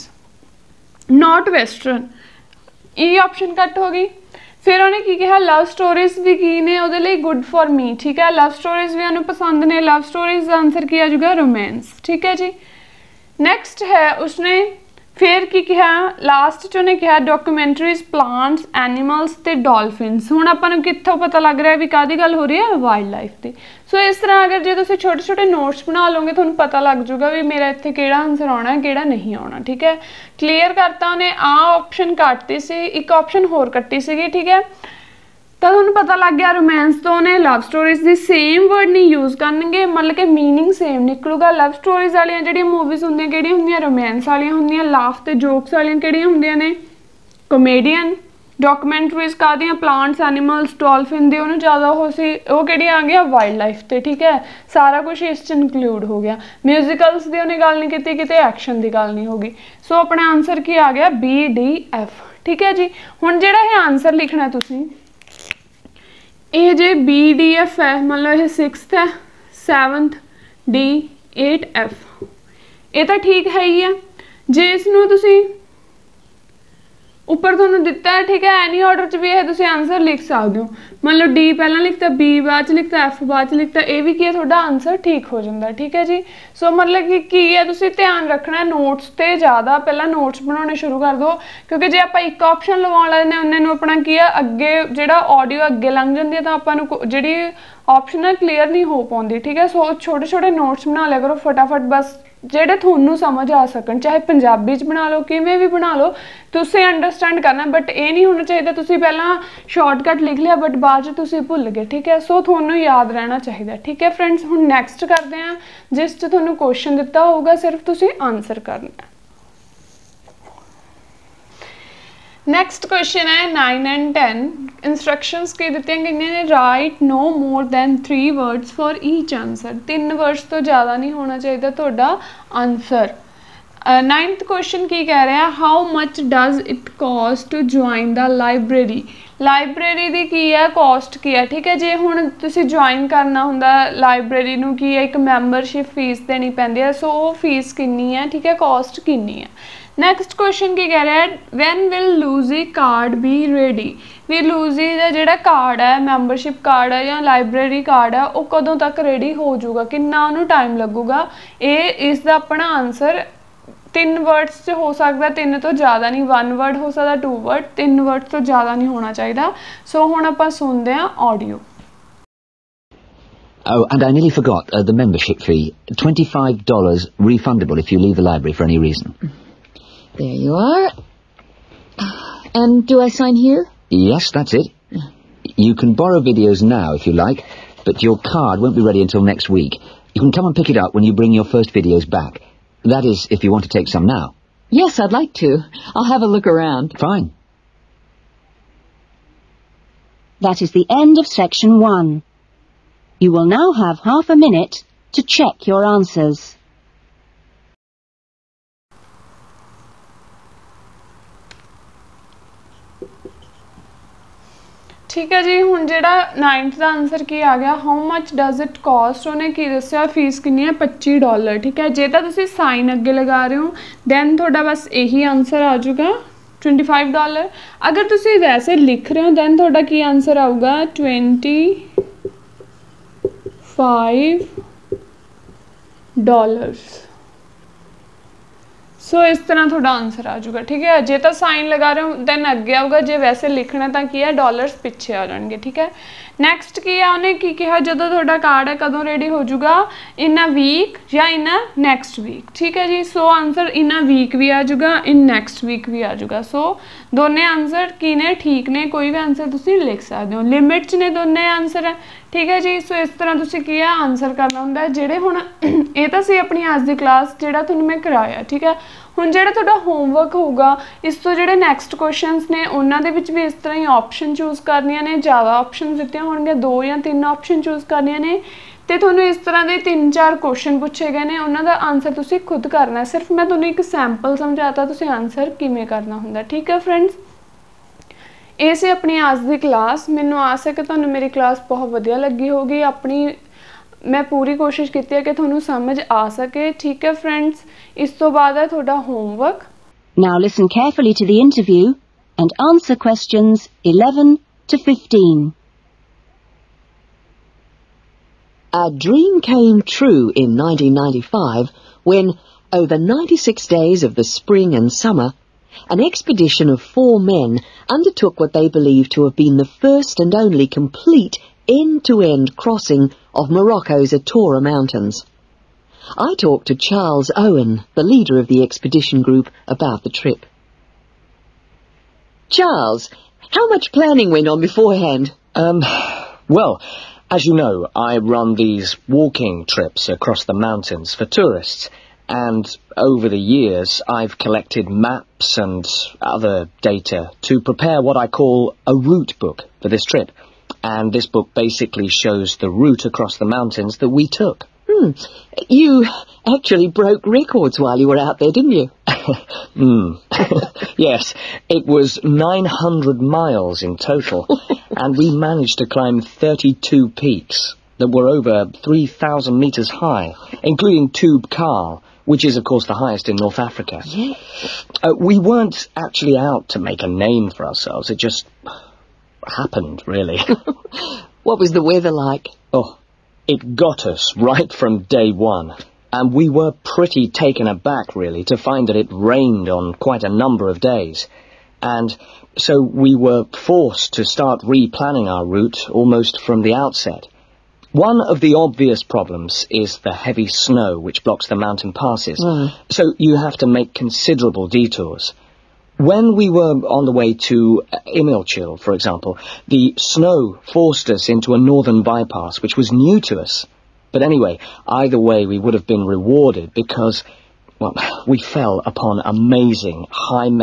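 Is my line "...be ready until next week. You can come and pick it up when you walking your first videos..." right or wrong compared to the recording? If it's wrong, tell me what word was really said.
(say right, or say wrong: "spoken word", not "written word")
wrong: "bring", not "walking".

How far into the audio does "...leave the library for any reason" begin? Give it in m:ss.
2:57.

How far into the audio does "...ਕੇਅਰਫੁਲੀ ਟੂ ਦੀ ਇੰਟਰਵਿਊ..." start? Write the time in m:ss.
5:00.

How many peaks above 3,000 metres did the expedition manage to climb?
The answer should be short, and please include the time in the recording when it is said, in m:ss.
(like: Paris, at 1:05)
32, at 6:06.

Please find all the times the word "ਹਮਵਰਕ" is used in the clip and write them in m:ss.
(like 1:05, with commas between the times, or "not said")
4:29, 4:59.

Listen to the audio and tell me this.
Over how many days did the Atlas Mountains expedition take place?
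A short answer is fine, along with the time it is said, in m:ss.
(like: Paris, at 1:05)
96, at 5:13.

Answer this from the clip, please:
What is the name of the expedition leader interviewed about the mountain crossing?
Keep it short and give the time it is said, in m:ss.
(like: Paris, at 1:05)
Charles Owen, at 5:26.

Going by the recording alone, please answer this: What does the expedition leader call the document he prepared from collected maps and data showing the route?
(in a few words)
route book.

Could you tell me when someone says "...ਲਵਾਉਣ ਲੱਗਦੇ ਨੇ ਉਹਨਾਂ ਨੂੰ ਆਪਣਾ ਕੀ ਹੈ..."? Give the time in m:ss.
1:32.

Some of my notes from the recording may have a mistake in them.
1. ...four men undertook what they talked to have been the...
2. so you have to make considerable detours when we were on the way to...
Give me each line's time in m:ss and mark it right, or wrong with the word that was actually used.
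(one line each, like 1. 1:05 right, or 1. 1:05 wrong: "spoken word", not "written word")
1. 5:16 wrong: "believed", not "talked"
2. 6:42 right.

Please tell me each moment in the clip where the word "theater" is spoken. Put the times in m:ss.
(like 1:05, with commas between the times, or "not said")
not said.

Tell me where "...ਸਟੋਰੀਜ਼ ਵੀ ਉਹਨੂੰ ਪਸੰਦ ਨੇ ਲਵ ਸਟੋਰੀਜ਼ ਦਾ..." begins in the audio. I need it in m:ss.
0:08.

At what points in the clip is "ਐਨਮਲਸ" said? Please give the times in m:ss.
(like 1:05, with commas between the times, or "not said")
0:18, 0:50.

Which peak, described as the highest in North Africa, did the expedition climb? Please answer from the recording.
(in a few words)
Tubkal.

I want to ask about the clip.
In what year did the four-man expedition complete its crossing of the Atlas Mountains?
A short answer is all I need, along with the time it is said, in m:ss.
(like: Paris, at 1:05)
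1995, at 5:10.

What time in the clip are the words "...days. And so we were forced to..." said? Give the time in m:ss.
6:30.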